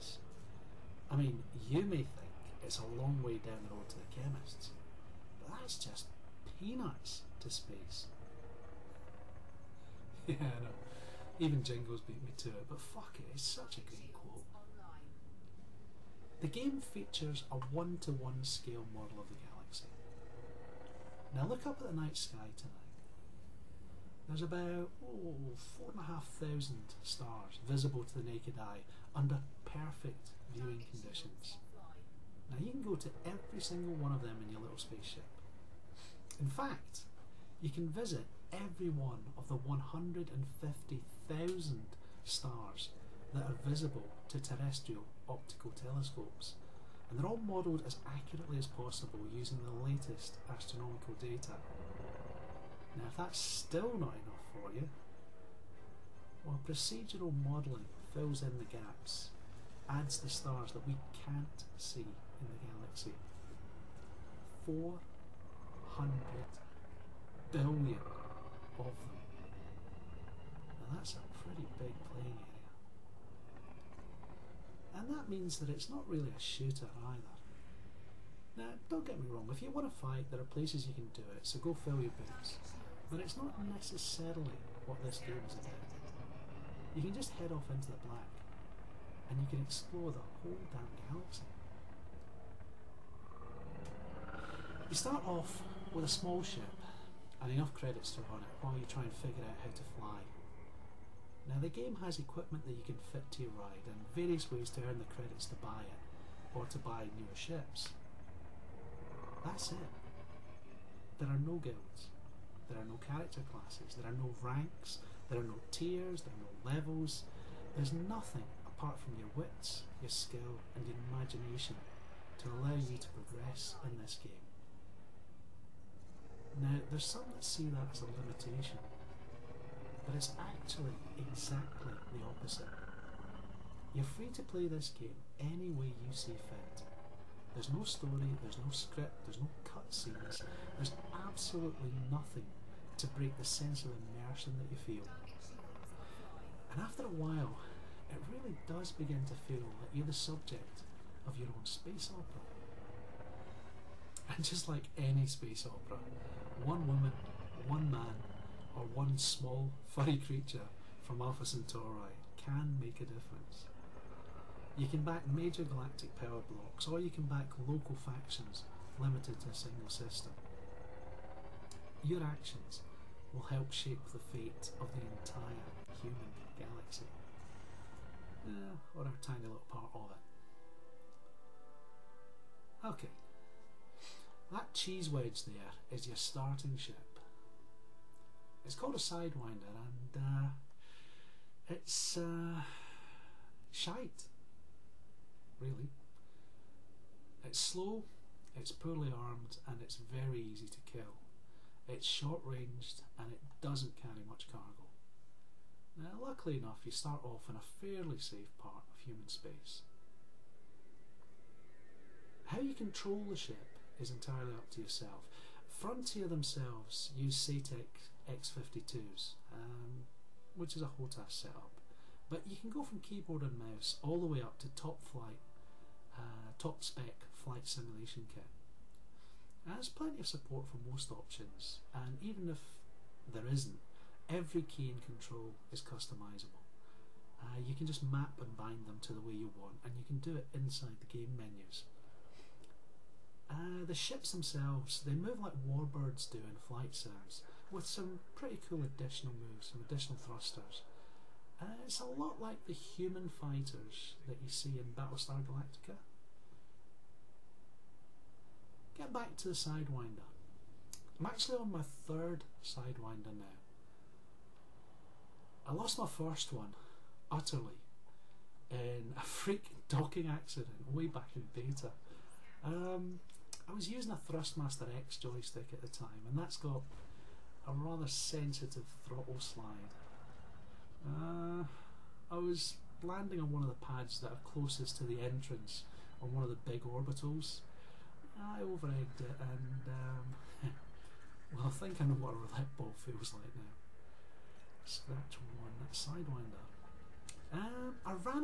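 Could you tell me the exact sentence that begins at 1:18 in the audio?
Now, don't get me wrong, if you want to fight, there are places you can do it, so go fill your boots.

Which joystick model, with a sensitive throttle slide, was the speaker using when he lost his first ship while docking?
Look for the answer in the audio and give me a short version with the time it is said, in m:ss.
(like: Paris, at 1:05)
Thrustmaster X, at 4:34.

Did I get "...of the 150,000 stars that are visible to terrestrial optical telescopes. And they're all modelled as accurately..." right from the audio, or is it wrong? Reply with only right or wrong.
right.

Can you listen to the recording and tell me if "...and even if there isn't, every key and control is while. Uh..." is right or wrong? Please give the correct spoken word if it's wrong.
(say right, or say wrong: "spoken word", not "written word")
wrong: "customizable", not "while".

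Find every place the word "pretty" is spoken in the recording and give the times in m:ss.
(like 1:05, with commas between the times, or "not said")
1:11, 4:08.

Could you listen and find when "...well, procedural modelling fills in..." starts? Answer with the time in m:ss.
0:56.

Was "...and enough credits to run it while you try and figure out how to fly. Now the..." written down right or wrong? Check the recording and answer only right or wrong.
right.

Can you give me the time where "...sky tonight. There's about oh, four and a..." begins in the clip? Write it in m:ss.
0:22.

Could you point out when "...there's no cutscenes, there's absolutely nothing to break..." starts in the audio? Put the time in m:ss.
2:19.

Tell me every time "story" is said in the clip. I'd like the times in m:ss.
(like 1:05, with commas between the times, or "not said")
2:17.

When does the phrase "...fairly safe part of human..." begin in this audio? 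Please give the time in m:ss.
3:27.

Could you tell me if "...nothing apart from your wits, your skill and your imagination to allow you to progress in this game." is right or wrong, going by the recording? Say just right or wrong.
right.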